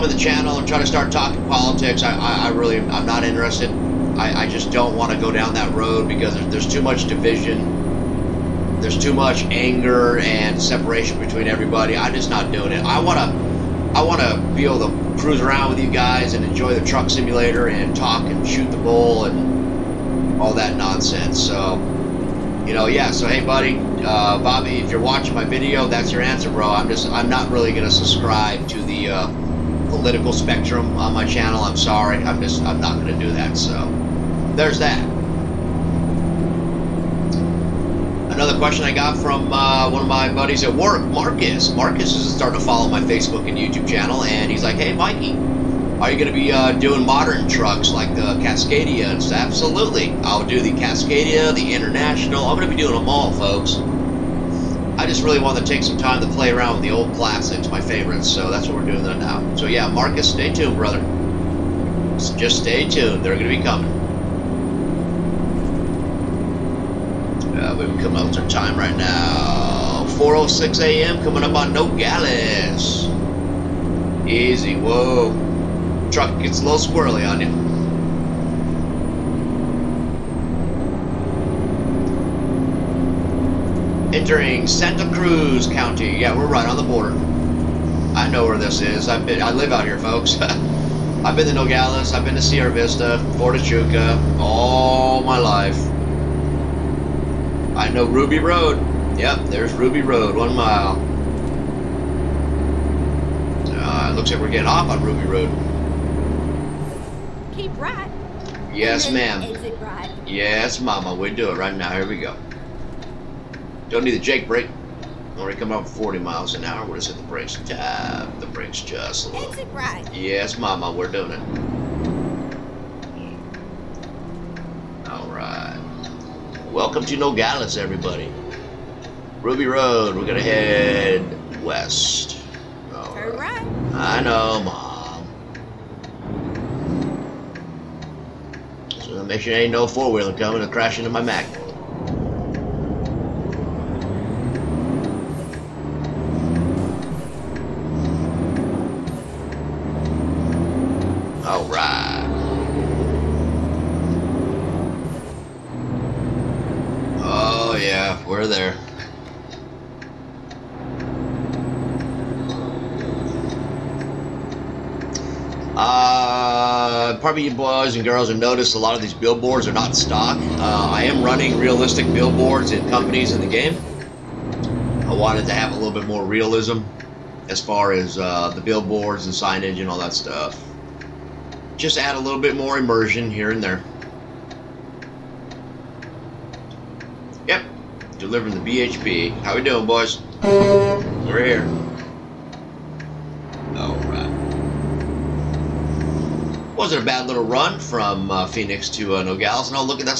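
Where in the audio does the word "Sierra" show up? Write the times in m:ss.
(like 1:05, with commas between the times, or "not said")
1:32.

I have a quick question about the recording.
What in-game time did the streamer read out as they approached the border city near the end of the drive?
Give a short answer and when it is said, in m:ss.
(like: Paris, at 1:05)
4:06 a.m., at 1:10.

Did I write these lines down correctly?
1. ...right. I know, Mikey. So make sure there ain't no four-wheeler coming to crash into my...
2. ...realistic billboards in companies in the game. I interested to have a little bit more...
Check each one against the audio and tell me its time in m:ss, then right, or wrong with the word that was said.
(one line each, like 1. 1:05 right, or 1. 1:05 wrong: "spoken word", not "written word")
1. 2:13 wrong: "Mom", not "Mikey"
2. 2:51 wrong: "wanted", not "interested".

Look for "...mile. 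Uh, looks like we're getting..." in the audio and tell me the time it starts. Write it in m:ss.
1:40.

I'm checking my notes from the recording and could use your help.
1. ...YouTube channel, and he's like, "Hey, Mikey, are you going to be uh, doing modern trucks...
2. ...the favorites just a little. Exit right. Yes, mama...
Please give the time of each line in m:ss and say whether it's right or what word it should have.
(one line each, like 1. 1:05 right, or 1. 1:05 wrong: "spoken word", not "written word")
1. 0:43 right
2. 1:58 wrong: "brakes", not "favorites".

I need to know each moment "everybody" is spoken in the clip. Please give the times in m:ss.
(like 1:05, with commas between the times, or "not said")
0:11, 2:07.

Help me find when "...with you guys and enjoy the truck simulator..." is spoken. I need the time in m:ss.
0:15.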